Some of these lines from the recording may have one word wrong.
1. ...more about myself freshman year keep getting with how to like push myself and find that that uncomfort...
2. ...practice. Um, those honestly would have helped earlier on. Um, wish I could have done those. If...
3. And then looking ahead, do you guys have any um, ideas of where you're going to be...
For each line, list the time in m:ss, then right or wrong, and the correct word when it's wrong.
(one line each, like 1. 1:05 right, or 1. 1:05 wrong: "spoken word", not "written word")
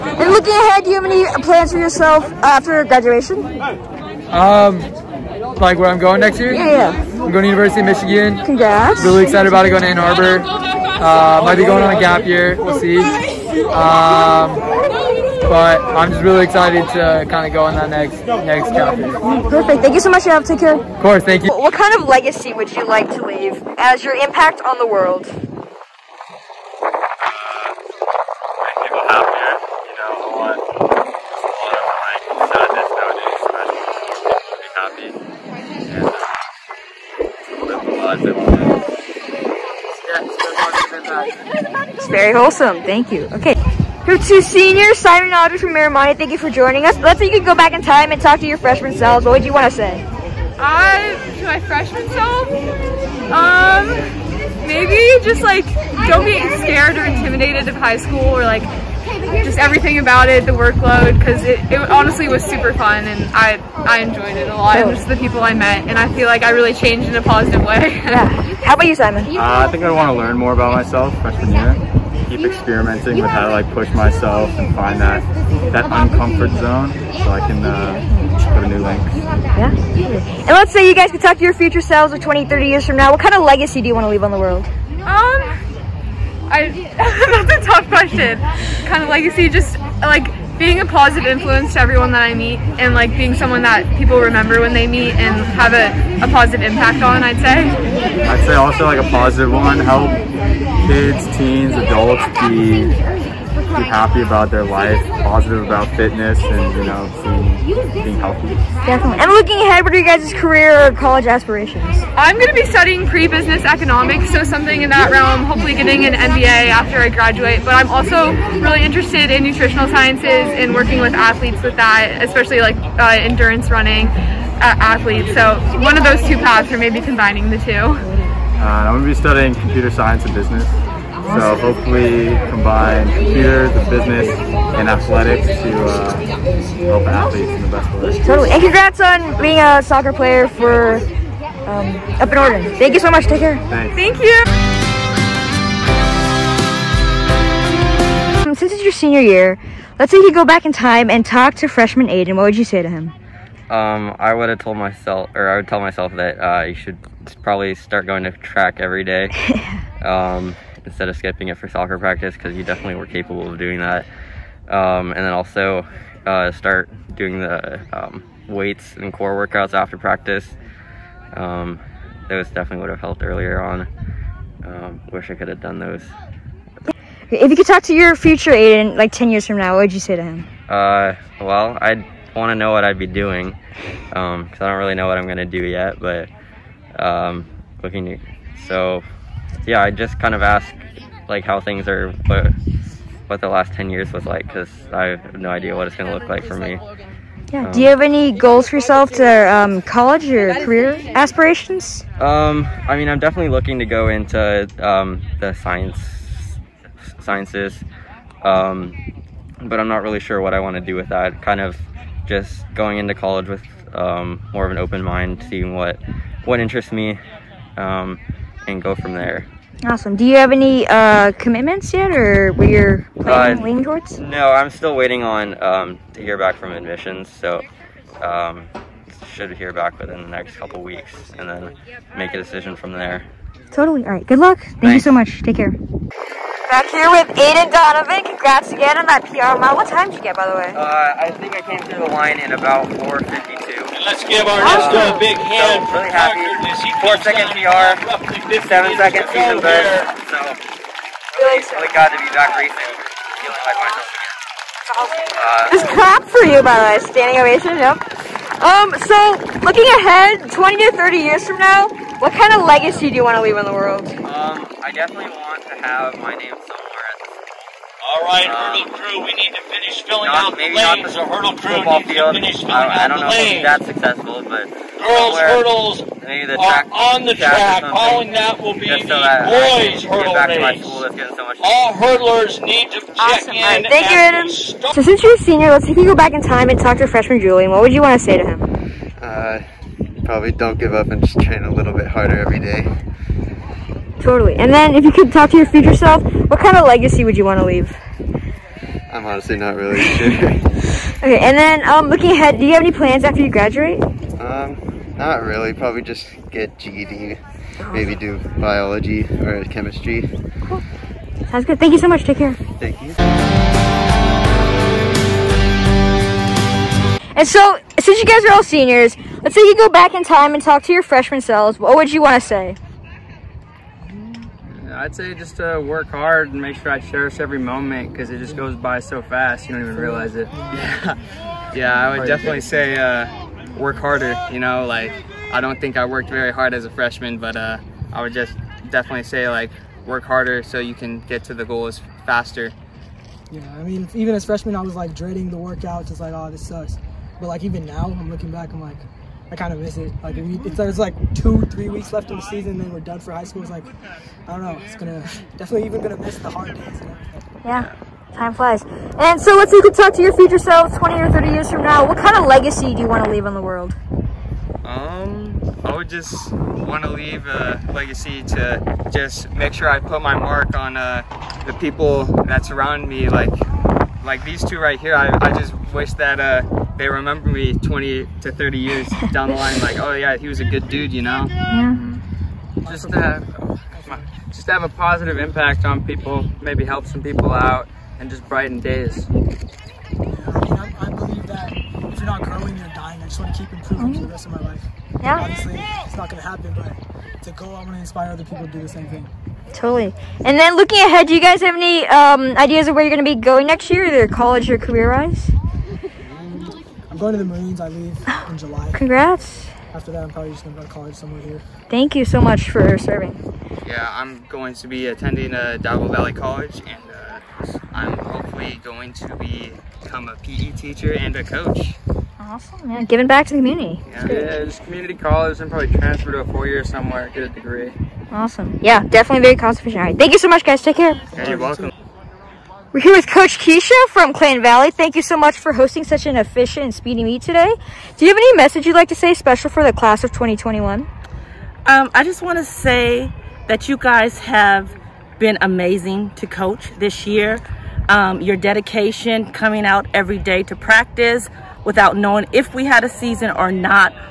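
1. 1:10 wrong: "experimenting", not "getting"
2. 2:49 wrong: "definitely", not "honestly"
3. 6:40 right.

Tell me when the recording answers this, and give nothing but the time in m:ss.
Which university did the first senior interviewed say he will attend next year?
0:07.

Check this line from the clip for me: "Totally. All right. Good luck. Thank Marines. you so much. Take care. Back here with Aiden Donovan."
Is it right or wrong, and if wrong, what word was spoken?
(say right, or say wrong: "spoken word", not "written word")
wrong: "Thanks", not "Marines".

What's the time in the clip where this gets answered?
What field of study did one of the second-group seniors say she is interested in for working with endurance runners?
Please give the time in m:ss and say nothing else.
1:59.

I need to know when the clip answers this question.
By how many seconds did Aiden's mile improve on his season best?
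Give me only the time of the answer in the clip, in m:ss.
4:08.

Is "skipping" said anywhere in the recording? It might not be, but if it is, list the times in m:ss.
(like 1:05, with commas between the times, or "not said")
2:41.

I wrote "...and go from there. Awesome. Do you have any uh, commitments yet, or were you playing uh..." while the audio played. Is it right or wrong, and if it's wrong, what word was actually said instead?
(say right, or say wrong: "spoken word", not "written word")
right.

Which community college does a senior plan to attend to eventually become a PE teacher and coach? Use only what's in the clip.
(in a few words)
Diablo Valley College.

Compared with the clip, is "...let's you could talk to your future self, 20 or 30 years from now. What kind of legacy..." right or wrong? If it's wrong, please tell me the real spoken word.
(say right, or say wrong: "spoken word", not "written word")
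right.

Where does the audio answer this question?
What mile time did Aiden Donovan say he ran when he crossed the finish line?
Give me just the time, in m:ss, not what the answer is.
4:02.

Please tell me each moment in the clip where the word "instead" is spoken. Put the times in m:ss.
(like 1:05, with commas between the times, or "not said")
2:40.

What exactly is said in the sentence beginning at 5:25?
I'd say just uh, work hard and make sure I cherish every moment because it just goes by so fast.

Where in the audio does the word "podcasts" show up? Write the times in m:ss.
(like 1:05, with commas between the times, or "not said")
not said.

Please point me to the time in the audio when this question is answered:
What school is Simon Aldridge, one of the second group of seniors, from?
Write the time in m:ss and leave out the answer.
0:45.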